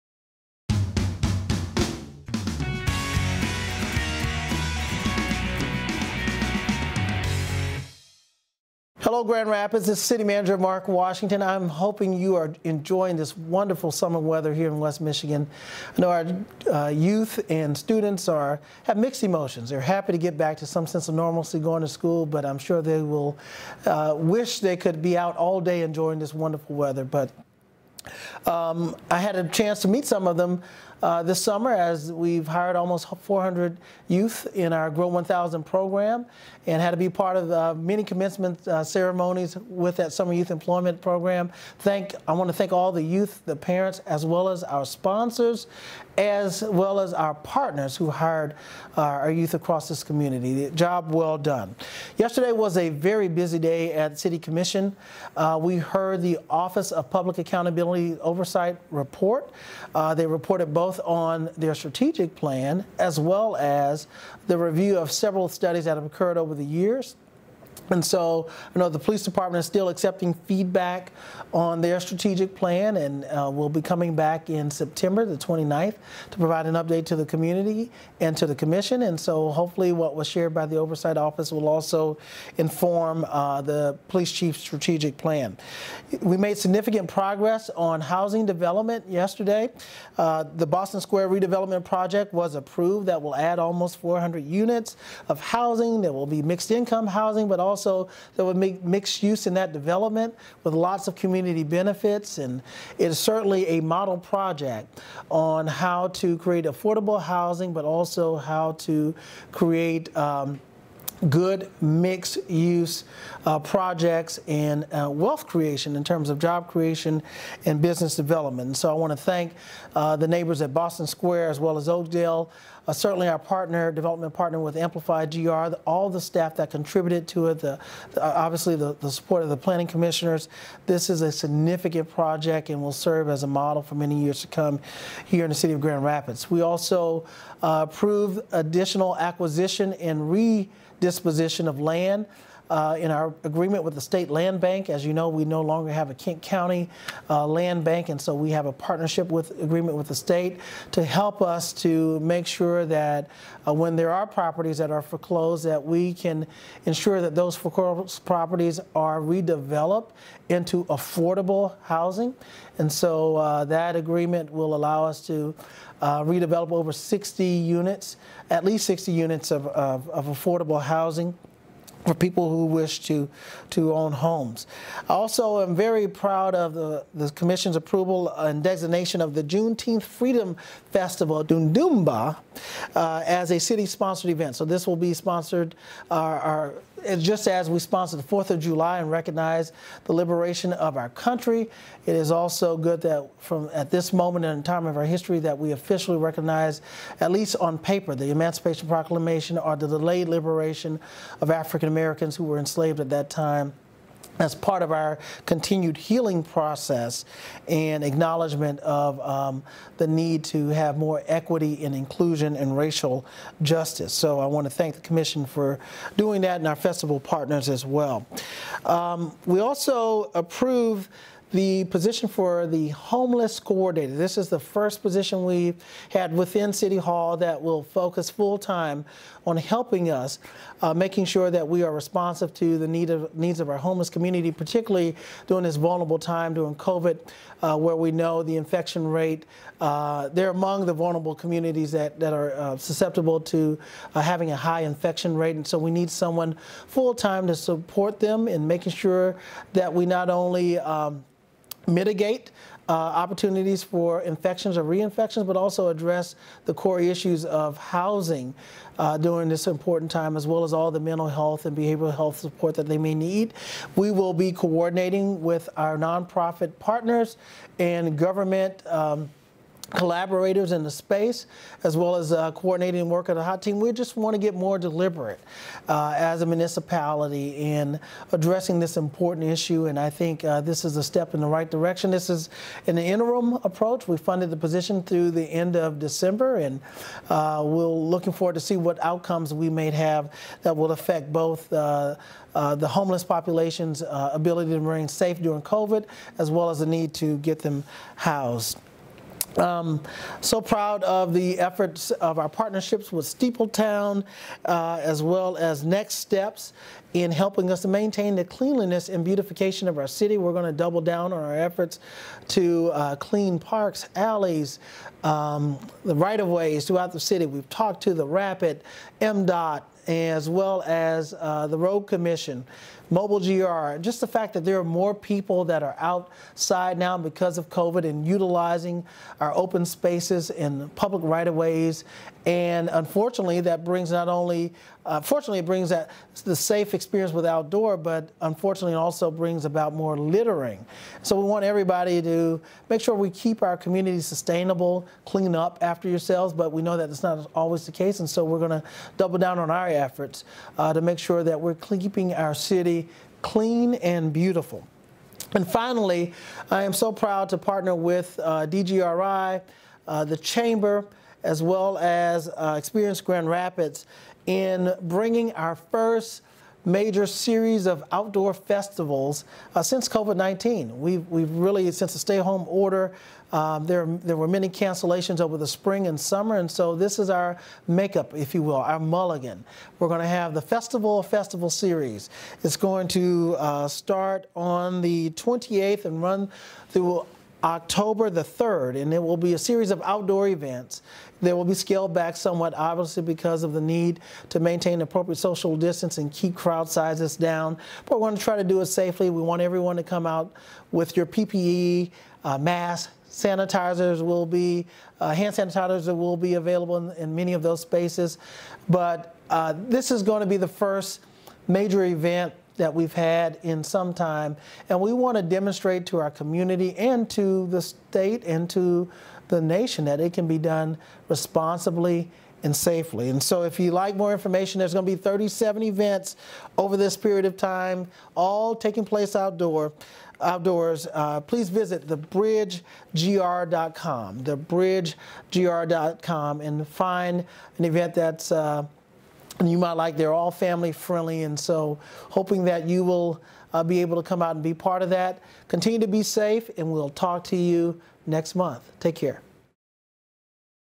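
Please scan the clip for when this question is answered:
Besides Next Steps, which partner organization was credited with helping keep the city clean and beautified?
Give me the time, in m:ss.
5:03.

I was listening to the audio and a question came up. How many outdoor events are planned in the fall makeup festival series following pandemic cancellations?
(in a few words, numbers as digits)
37.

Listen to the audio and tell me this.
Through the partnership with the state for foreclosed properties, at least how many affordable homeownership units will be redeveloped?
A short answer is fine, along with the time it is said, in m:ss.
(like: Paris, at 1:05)
60, at 2:48.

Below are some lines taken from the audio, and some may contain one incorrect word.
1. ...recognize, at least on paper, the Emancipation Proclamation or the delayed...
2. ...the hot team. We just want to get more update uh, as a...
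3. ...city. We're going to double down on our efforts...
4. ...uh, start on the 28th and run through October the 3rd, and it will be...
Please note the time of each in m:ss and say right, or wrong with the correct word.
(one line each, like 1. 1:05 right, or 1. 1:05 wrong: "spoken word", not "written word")
1. 3:16 right
2. 4:33 wrong: "deliberate", not "update"
3. 5:10 right
4. 6:23 right.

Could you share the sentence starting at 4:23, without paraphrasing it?
We will be coordinating with our nonprofit partners and government.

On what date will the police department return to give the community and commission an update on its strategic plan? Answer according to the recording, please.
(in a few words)
September 29.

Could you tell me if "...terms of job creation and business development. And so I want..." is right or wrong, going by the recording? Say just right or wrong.
right.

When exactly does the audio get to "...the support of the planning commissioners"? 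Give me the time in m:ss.
2:08.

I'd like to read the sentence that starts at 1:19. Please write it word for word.
And so, hopefully, what was shared by the oversight office will also inform uh, the police chief's strategic plan.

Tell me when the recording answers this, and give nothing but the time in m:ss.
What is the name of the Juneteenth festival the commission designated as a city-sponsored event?
3:01.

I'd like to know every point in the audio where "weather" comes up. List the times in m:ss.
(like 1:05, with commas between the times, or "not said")
0:14, 0:26.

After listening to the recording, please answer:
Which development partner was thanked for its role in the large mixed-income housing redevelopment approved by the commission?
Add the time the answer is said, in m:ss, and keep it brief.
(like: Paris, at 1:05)
Amplify GR, at 2:04.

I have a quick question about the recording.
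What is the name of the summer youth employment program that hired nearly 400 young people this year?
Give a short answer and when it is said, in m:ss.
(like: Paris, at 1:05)
GRow 1000, at 0:34.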